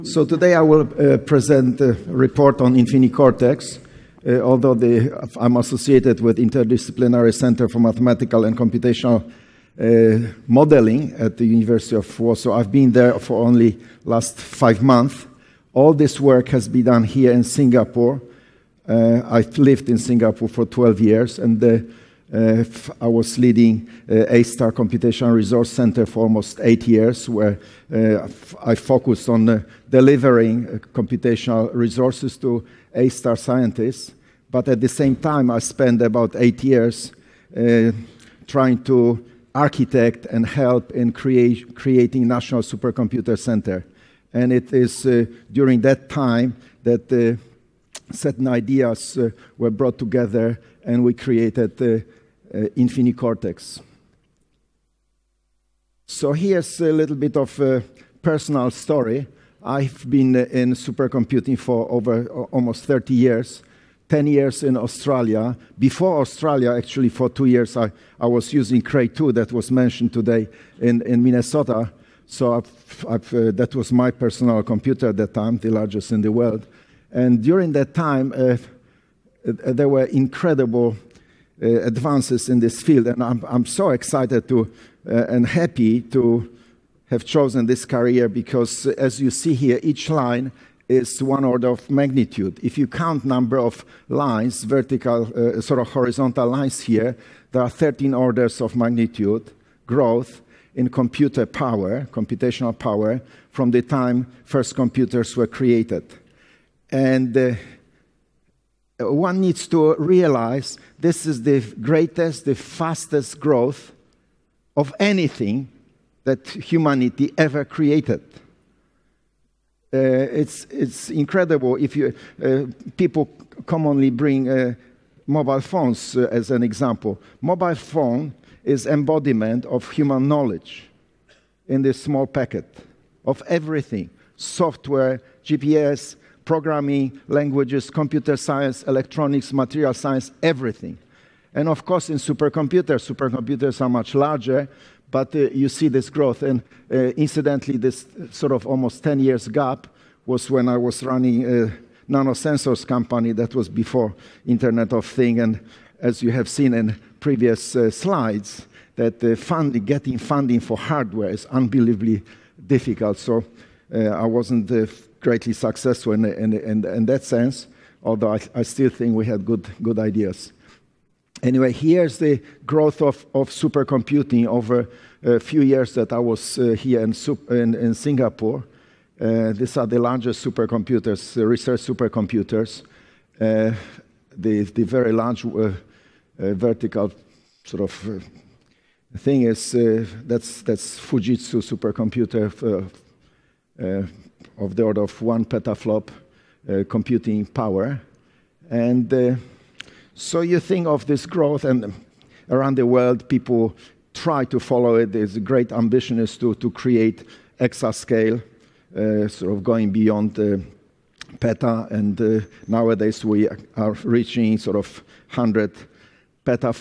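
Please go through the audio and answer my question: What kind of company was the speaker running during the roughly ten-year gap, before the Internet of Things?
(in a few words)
nanosensors company.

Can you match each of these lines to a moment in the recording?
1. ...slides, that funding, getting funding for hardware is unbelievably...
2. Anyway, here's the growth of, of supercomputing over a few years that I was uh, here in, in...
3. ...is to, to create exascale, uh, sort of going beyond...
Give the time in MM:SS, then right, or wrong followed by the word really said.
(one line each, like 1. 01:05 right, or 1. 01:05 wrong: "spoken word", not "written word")
1. 02:37 right
2. 02:51 right
3. 03:26 right.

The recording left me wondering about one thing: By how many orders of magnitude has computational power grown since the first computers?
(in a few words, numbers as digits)
13.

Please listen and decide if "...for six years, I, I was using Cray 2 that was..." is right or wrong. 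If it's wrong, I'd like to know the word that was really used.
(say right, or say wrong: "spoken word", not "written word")
wrong: "two", not "six".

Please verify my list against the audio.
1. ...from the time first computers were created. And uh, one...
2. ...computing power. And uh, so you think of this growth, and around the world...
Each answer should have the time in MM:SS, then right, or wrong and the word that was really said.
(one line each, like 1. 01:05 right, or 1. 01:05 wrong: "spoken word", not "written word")
1. 01:43 right
2. 03:16 right.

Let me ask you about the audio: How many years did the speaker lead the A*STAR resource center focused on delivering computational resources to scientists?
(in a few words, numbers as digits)
8.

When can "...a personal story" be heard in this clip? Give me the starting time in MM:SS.
00:57.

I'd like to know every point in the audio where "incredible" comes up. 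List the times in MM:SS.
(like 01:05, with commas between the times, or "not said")
01:20, 02:01.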